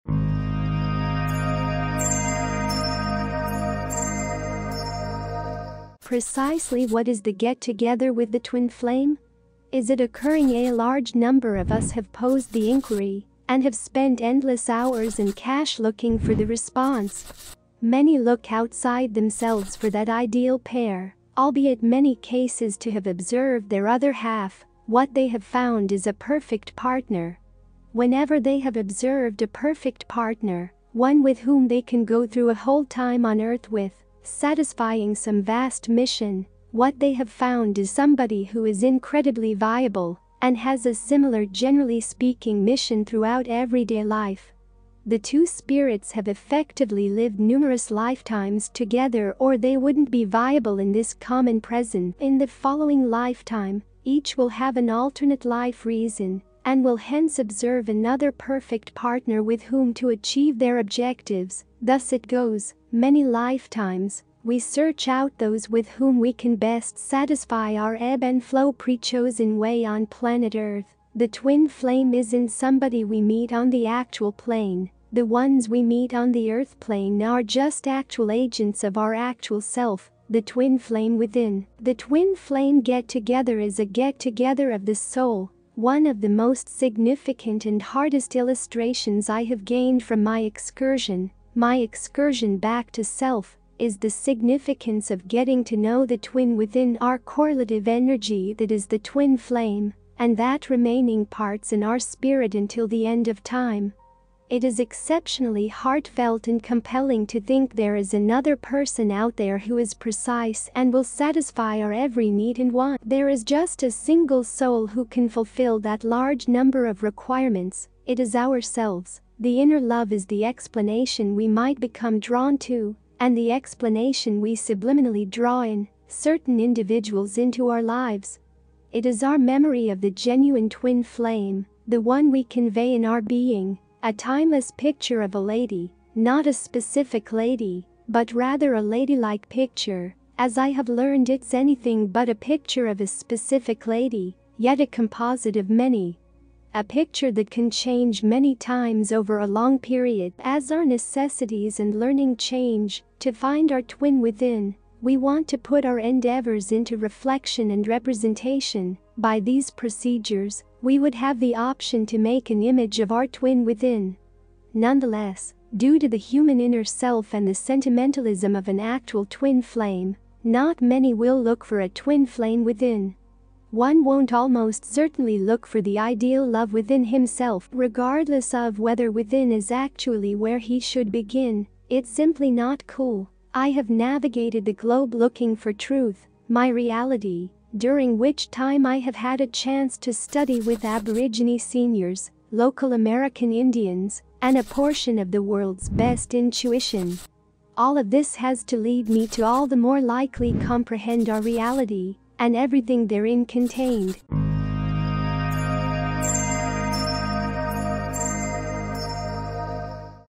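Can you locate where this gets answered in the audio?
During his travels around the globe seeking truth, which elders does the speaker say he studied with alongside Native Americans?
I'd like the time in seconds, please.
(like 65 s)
190 s.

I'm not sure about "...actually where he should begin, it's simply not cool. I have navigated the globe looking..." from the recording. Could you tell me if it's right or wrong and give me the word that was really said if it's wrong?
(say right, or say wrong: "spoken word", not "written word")
right.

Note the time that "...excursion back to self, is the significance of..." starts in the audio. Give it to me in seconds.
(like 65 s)
91 s.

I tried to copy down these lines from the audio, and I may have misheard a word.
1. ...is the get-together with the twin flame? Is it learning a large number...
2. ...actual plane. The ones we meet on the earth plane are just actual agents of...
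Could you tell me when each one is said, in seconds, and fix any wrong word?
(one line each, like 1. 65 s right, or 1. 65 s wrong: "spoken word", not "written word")
1. 7 s wrong: "occurring", not "learning"
2. 73 s right.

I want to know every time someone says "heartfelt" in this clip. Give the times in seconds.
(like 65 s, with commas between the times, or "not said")
105 s.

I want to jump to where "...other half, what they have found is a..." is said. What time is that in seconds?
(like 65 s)
23 s.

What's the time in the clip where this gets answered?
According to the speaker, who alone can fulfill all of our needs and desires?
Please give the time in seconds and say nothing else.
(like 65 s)
118 s.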